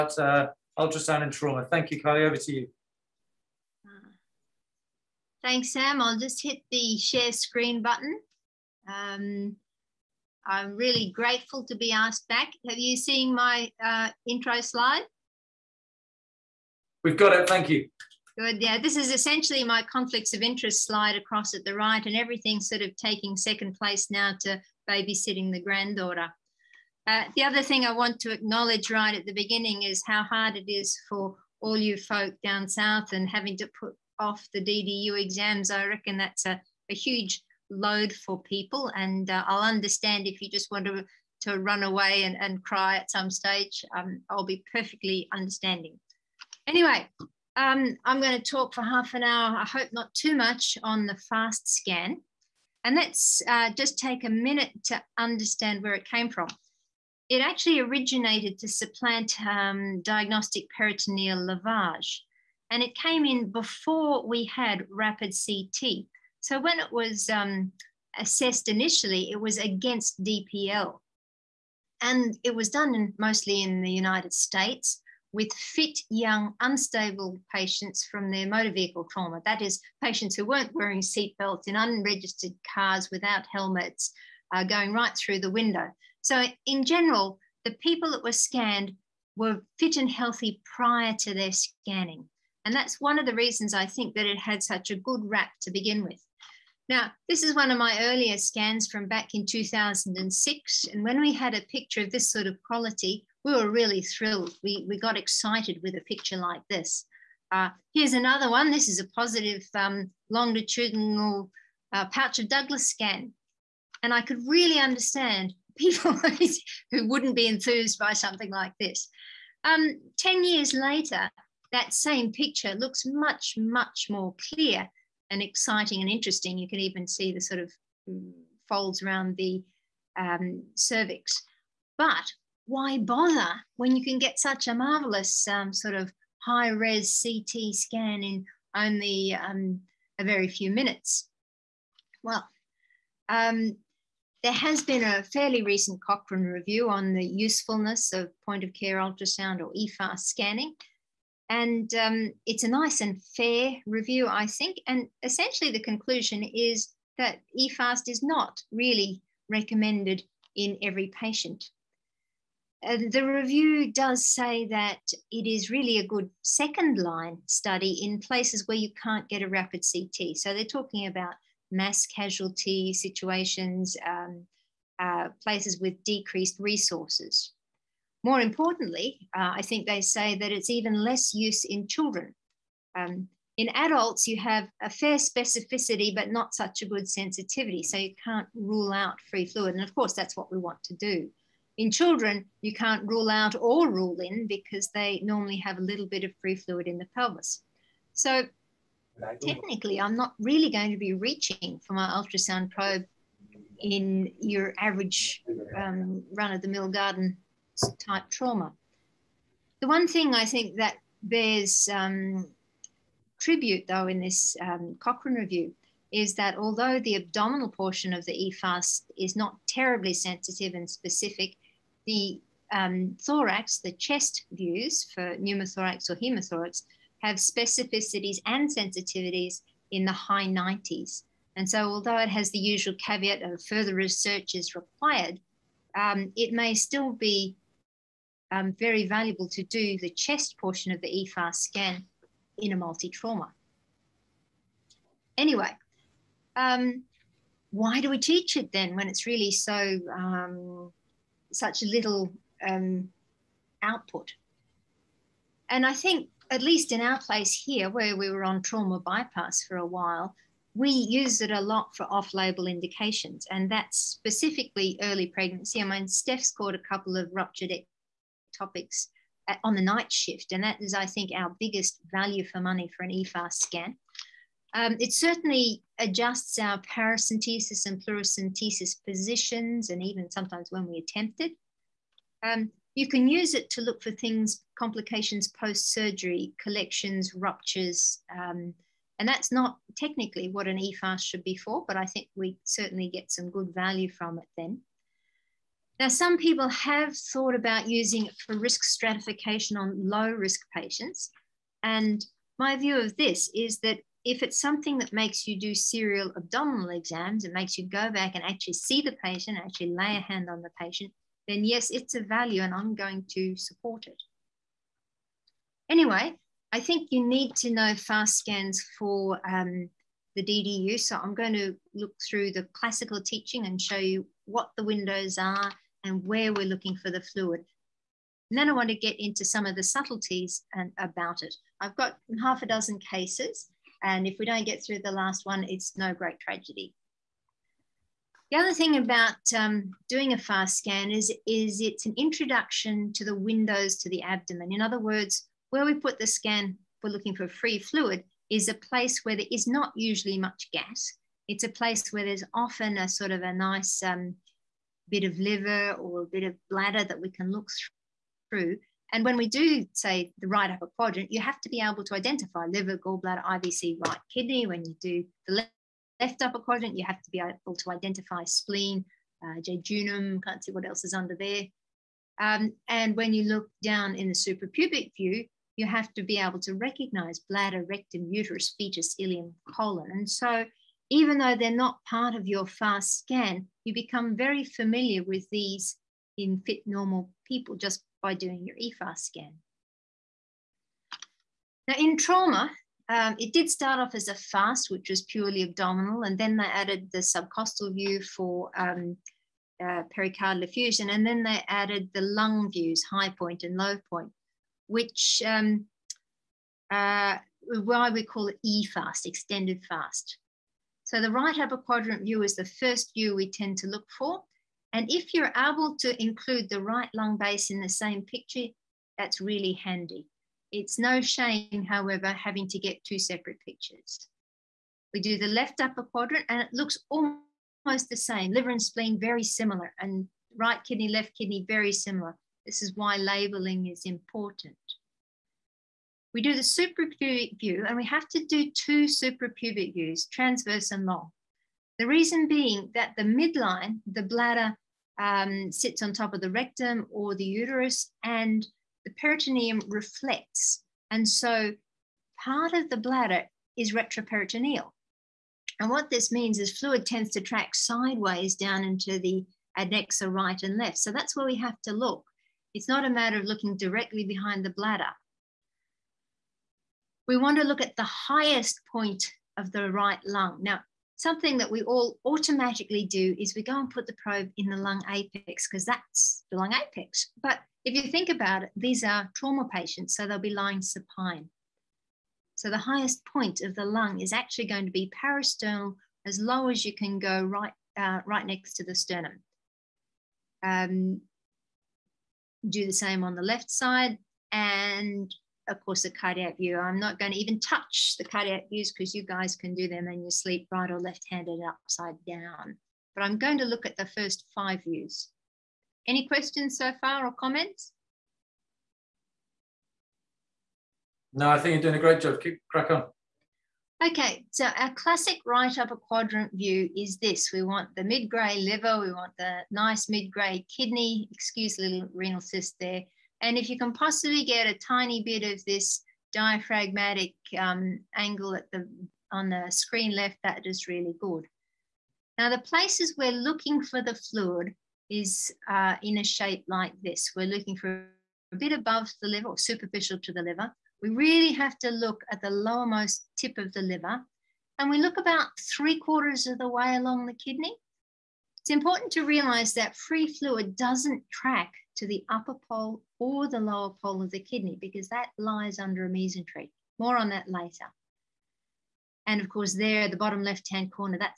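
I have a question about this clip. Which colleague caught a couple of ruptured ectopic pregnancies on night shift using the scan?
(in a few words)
Steph.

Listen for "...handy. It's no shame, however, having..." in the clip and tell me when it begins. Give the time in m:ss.
6:59.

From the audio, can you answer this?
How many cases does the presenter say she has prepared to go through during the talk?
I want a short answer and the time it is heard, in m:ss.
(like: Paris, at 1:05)
half a dozen, at 5:32.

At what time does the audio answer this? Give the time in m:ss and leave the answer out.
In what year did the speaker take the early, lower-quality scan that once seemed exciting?
1:39.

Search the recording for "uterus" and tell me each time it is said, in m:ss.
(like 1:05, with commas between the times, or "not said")
6:18, 7:27.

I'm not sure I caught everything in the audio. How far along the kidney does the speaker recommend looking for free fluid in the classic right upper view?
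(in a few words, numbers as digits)
three quarters.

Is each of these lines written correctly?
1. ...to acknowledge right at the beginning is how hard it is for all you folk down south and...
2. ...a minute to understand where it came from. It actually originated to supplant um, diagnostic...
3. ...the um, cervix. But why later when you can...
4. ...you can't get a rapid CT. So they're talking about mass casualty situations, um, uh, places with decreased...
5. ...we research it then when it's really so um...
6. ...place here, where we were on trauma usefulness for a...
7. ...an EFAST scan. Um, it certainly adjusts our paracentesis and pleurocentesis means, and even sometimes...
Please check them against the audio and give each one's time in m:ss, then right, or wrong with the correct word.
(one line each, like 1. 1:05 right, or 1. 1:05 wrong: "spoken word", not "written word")
1. 0:28 right
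2. 0:54 right
3. 2:09 wrong: "bother", not "later"
4. 2:48 right
5. 4:08 wrong: "teach", not "research"
6. 4:17 wrong: "bypass", not "usefulness"
7. 4:33 wrong: "positions", not "means".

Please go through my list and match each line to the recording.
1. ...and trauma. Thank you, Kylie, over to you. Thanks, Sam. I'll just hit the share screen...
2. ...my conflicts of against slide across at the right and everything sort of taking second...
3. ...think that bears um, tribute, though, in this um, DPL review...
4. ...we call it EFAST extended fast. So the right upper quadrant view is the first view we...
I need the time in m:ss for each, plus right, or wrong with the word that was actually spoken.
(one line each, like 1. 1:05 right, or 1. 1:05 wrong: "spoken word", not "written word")
1. 0:01 right
2. 0:19 wrong: "interest", not "against"
3. 3:30 wrong: "Cochrane", not "DPL"
4. 6:48 right.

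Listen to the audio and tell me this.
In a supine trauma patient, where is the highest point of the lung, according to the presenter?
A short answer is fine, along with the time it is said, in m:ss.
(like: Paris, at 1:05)
Parasternal, at 8:05.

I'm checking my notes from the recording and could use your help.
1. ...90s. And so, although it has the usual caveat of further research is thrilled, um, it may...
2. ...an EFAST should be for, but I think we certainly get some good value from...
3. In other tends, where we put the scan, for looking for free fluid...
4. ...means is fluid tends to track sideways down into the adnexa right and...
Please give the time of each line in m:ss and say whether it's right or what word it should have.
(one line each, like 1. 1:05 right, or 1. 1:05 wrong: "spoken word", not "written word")
1. 3:50 wrong: "required", not "thrilled"
2. 4:50 right
3. 5:44 wrong: "words", not "tends"
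4. 7:36 right.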